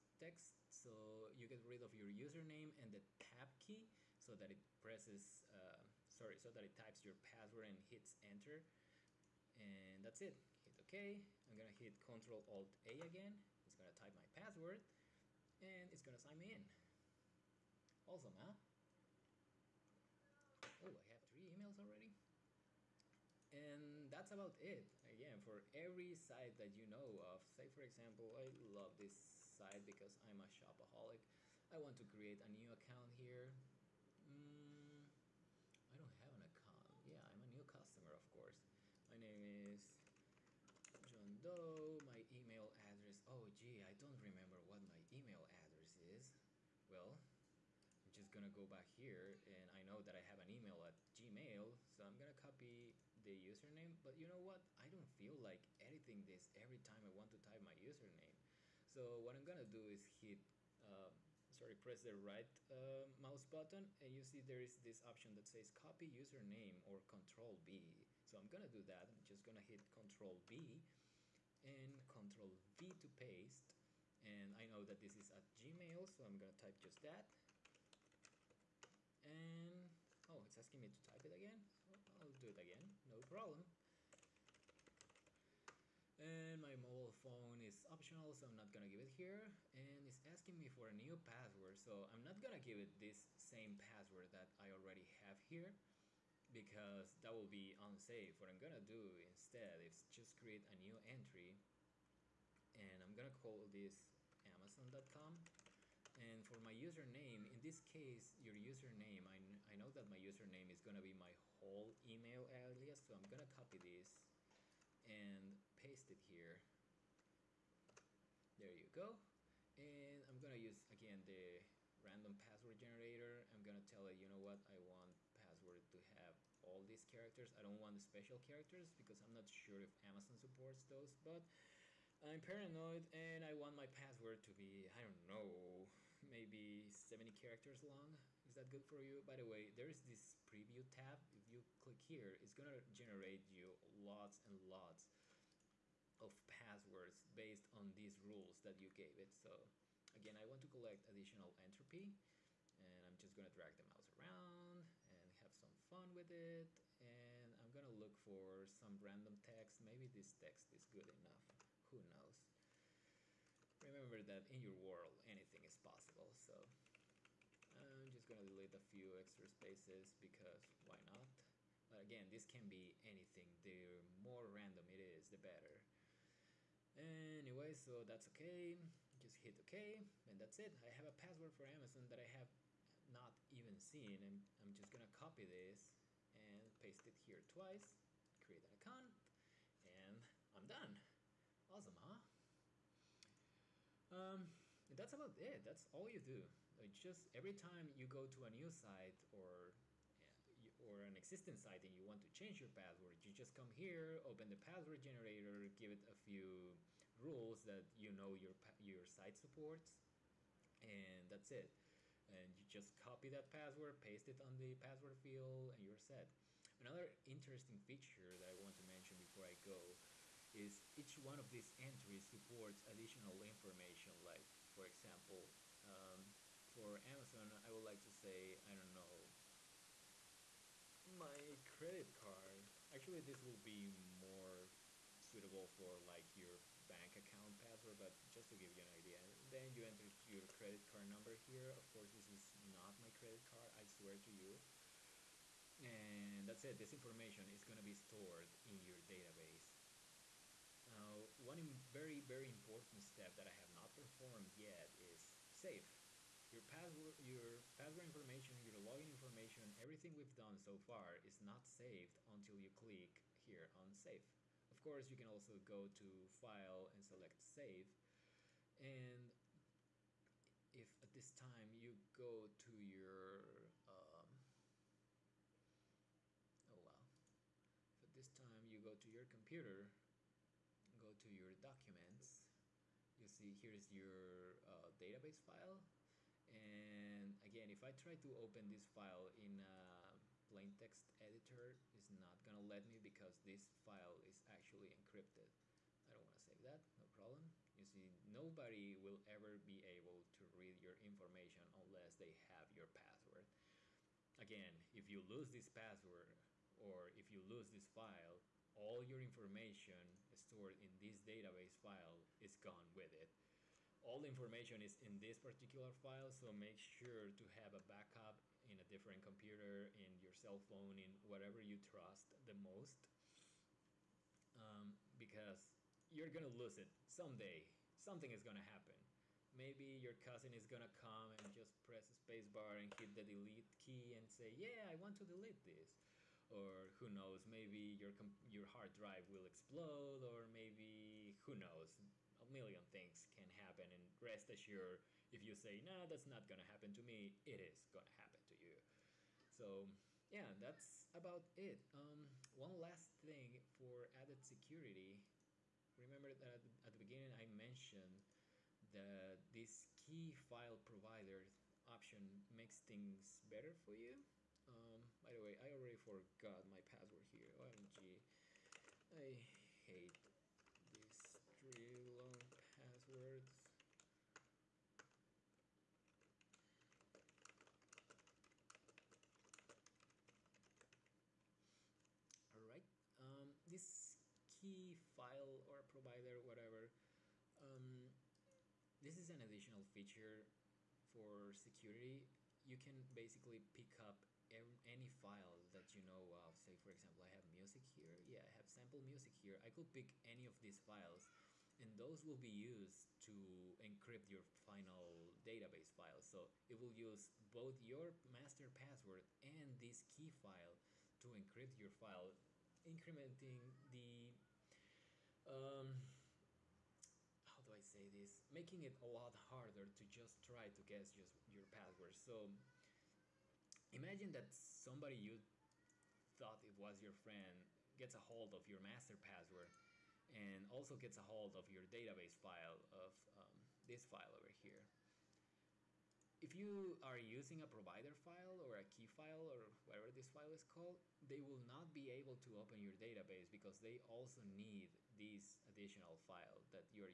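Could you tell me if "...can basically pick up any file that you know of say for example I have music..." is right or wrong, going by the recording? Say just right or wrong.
right.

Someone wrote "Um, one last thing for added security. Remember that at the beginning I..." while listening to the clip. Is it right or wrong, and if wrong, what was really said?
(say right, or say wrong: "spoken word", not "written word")
right.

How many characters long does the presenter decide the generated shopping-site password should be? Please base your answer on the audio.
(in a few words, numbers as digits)
70.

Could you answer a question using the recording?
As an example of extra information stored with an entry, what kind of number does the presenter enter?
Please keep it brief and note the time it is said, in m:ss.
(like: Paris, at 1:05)
credit card number, at 4:00.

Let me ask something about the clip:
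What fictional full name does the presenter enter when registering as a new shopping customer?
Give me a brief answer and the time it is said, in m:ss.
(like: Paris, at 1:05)
John Doe, at 0:41.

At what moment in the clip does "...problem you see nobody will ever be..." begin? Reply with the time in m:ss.
4:57.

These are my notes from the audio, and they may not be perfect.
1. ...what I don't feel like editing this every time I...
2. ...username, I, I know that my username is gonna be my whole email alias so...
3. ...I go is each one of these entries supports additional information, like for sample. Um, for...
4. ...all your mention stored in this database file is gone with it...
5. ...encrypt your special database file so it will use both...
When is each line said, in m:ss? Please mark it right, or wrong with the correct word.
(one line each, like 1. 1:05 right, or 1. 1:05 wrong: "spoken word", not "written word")
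1. 0:54 right
2. 1:48 right
3. 3:39 wrong: "example", not "sample"
4. 5:08 wrong: "information", not "mention"
5. 6:43 wrong: "final", not "special".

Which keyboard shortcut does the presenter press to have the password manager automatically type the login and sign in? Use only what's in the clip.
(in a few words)
Control Alt A.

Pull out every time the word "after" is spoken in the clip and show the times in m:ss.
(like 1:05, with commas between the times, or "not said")
not said.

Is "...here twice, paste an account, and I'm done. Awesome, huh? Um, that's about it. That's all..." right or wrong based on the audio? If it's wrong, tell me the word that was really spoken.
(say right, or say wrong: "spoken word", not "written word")
wrong: "create", not "paste".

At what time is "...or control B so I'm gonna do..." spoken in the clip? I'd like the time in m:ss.
1:06.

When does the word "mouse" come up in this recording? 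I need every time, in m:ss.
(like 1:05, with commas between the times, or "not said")
1:03, 2:33.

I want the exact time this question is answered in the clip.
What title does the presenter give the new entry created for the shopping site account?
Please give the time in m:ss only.
1:44.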